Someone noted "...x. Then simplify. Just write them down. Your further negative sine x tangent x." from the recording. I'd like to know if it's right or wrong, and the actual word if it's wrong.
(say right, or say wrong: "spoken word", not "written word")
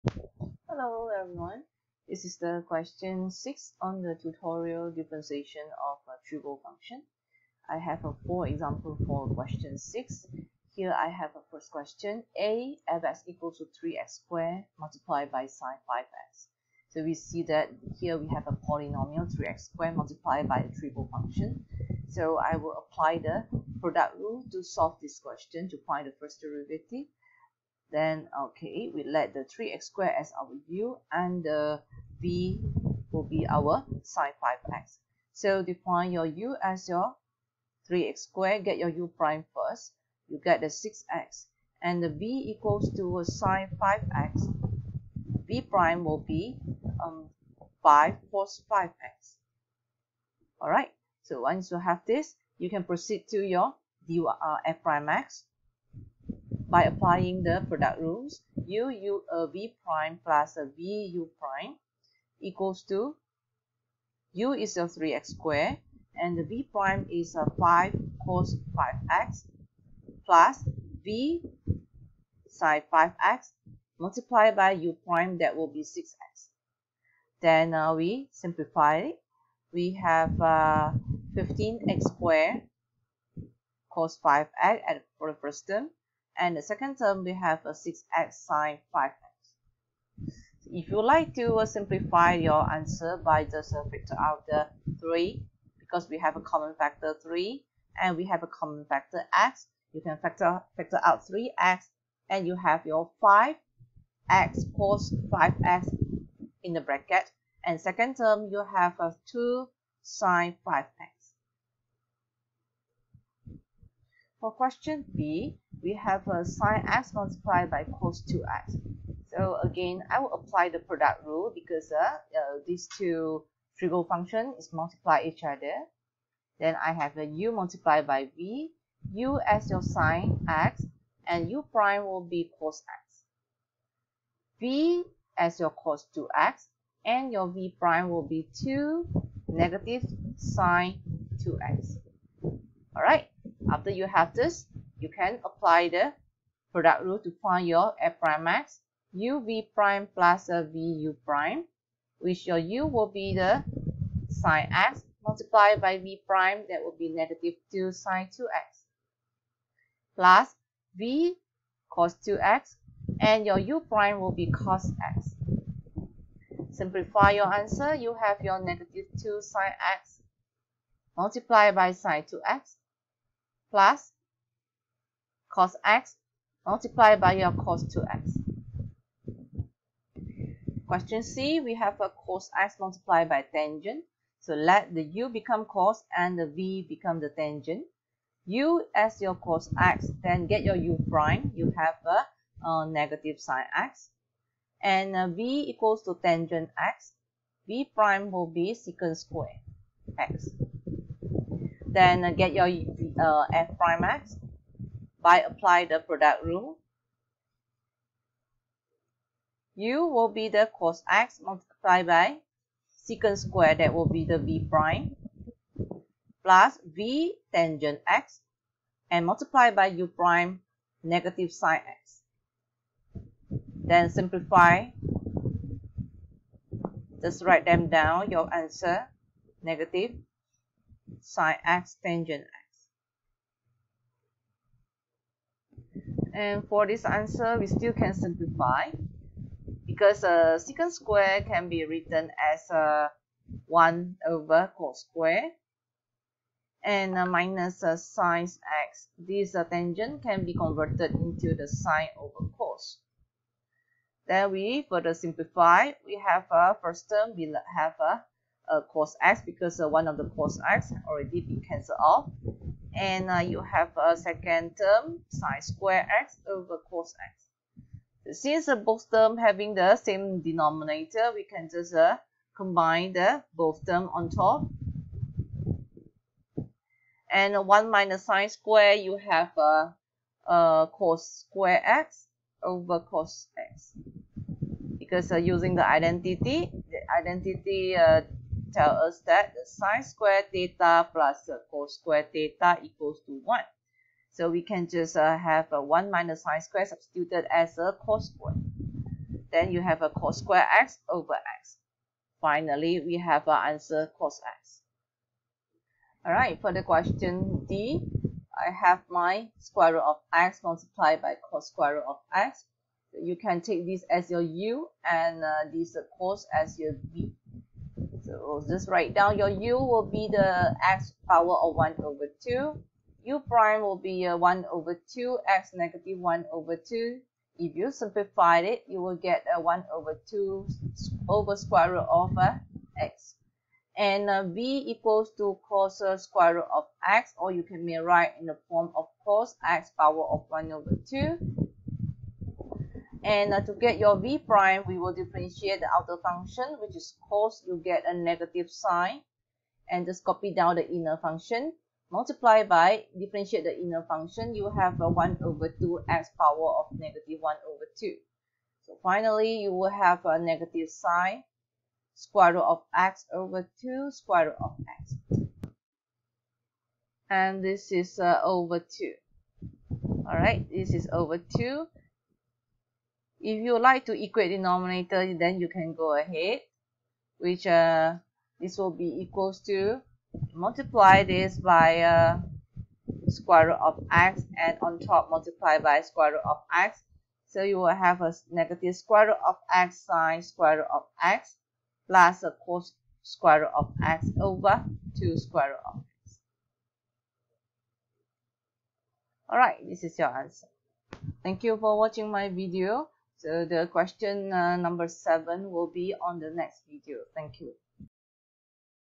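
wrong: "answer", not "further".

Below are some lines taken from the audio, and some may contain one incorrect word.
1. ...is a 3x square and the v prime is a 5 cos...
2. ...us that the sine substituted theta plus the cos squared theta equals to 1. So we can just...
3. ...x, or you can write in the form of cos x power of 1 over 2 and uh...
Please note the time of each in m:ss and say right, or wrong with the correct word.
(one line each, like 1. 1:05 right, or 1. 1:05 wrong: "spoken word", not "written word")
1. 1:04 right
2. 4:48 wrong: "squared", not "substituted"
3. 5:37 right.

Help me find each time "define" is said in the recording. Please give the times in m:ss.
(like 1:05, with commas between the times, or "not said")
0:35.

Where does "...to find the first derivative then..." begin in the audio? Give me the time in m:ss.
0:25.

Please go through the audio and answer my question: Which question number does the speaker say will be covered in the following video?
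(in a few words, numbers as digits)
7.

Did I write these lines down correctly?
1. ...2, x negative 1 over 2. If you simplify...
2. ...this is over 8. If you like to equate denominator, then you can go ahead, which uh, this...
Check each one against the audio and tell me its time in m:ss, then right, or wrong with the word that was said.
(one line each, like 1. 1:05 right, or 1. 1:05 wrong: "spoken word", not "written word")
1. 5:25 right
2. 6:10 wrong: "2", not "8".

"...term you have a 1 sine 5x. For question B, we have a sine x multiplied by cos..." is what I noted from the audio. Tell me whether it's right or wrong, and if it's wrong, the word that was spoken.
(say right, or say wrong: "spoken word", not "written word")
wrong: "2", not "1".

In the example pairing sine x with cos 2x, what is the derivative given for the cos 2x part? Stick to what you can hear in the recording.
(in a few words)
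negative 2 sine 2x.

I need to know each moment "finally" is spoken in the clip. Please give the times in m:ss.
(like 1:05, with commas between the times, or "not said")
5:02, 5:59.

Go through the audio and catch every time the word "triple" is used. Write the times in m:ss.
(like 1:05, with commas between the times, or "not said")
0:06, 0:20.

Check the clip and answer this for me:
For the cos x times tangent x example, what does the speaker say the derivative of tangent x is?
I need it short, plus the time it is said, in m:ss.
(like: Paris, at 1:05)
secant square x, at 3:18.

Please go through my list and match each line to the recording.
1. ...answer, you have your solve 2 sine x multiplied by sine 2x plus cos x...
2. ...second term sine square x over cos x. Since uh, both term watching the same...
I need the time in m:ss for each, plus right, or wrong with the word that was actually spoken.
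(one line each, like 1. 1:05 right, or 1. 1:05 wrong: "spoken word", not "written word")
1. 2:47 wrong: "negative", not "solve"
2. 4:24 wrong: "having", not "watching".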